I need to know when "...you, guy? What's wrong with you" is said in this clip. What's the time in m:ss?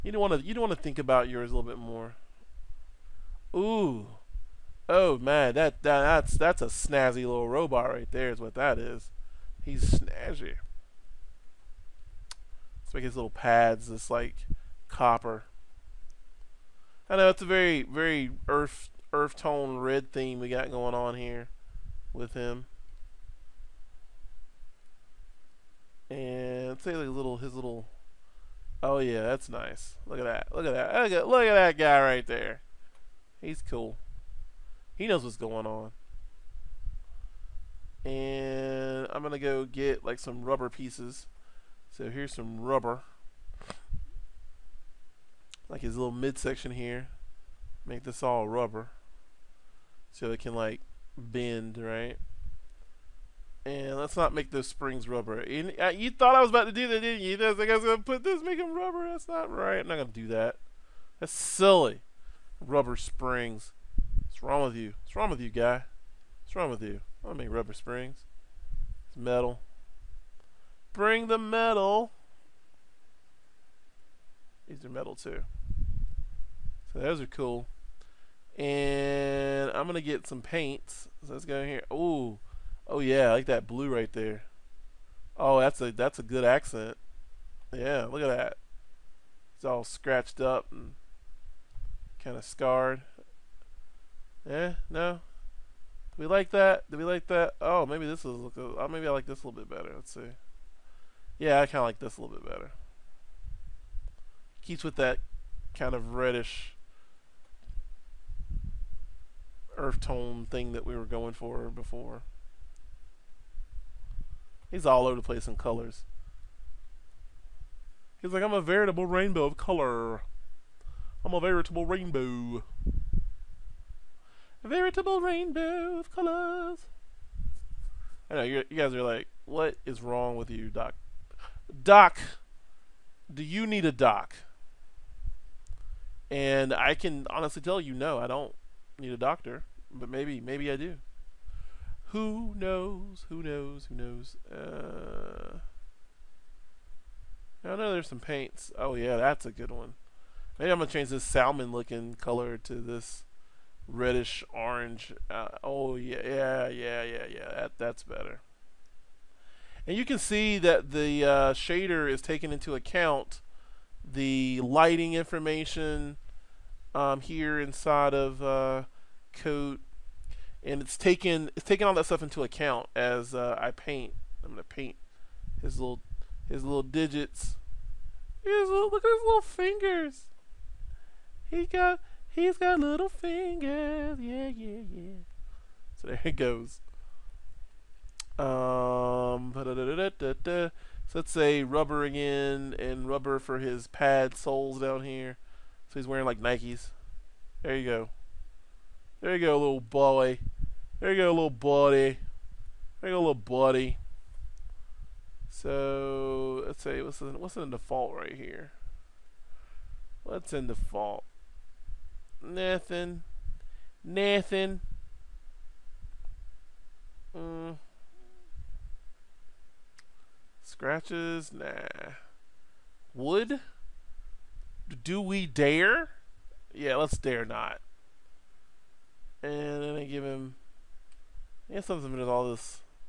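1:05.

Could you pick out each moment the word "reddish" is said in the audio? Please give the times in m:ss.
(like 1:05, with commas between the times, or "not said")
1:46, 2:33.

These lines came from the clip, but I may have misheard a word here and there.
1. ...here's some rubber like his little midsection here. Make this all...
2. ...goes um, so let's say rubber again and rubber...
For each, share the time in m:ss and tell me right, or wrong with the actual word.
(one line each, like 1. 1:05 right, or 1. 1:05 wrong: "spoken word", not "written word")
1. 0:42 right
2. 3:06 right.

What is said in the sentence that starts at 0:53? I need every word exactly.
And let's not make those springs rubber.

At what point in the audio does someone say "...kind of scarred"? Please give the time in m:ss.
1:32.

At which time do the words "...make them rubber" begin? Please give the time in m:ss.
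0:58.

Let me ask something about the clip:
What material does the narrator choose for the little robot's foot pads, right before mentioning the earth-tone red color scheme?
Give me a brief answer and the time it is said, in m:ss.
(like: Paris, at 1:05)
Copper, at 0:14.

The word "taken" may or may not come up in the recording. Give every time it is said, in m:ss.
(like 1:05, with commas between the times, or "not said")
2:42, 2:50.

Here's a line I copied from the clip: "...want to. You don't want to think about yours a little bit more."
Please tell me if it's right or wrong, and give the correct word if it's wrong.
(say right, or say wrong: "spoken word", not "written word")
right.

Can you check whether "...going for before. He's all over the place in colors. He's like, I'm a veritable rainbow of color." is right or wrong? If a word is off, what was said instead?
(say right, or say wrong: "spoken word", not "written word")
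right.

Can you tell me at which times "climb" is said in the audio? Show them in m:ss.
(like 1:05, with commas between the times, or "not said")
not said.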